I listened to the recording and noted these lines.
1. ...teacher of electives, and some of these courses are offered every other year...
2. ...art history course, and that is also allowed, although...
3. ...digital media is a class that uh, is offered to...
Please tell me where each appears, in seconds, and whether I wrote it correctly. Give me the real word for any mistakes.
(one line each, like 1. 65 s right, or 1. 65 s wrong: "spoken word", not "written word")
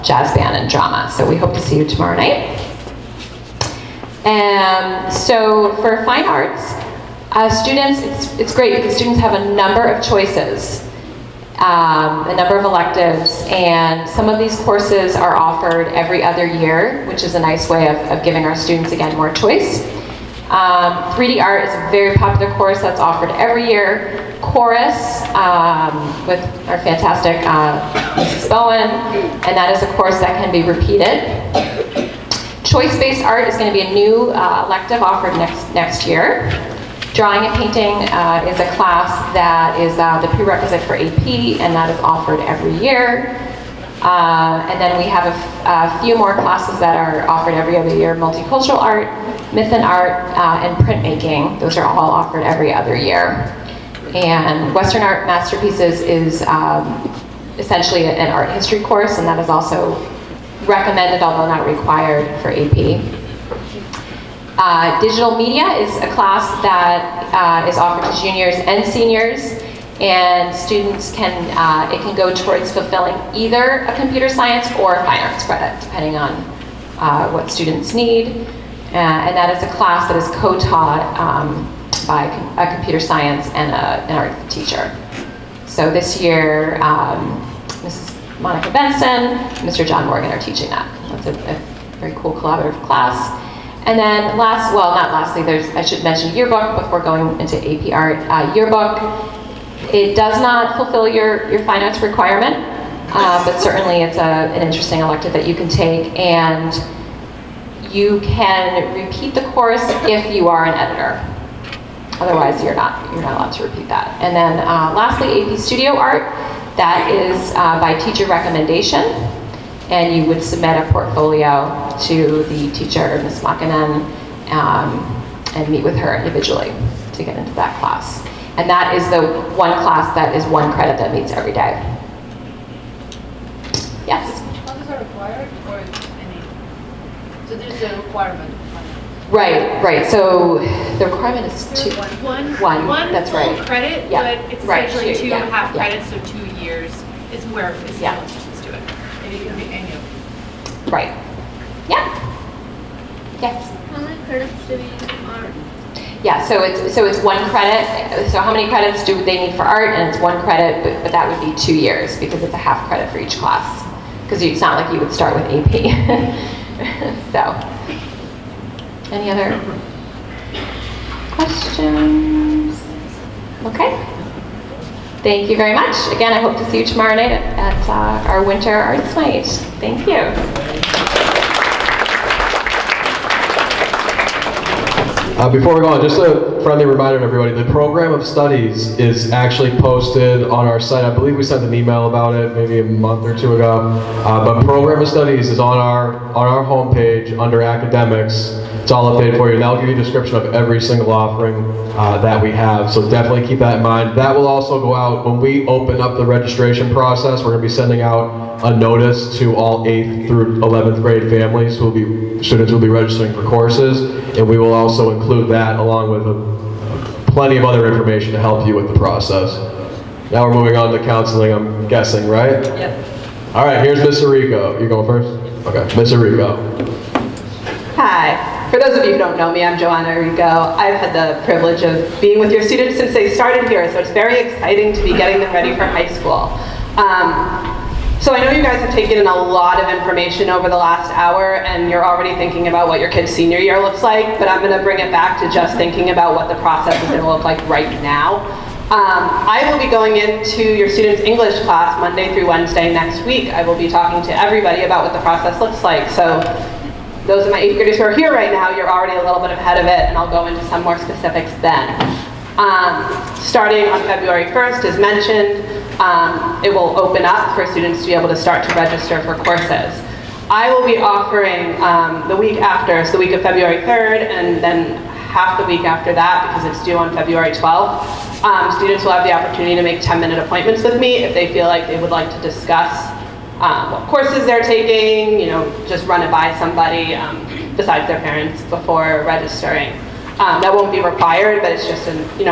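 1. 12 s wrong: "number", not "teacher"
2. 58 s wrong: "recommended", not "allowed"
3. 64 s right.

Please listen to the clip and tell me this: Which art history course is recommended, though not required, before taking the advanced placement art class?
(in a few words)
Western Art Masterpieces.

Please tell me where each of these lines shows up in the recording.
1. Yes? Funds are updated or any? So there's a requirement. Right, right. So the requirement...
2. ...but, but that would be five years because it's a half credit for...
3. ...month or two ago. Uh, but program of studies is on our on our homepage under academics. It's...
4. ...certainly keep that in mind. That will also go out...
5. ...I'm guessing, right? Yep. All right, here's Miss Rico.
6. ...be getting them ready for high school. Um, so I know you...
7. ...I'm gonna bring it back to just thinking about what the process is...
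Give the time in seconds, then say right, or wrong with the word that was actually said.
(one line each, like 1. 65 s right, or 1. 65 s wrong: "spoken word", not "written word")
1. 134 s wrong: "required", not "updated"
2. 160 s wrong: "two", not "five"
3. 192 s right
4. 203 s wrong: "definitely", not "certainly"
5. 221 s right
6. 235 s right
7. 244 s right.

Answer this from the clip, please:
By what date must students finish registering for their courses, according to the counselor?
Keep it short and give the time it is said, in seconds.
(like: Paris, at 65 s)
February 12th, at 277 s.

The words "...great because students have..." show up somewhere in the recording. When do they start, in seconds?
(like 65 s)
8 s.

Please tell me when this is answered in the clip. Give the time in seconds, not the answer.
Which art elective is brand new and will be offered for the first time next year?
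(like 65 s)
32 s.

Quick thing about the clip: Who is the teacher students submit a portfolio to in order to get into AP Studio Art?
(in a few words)
Ms. Makanen.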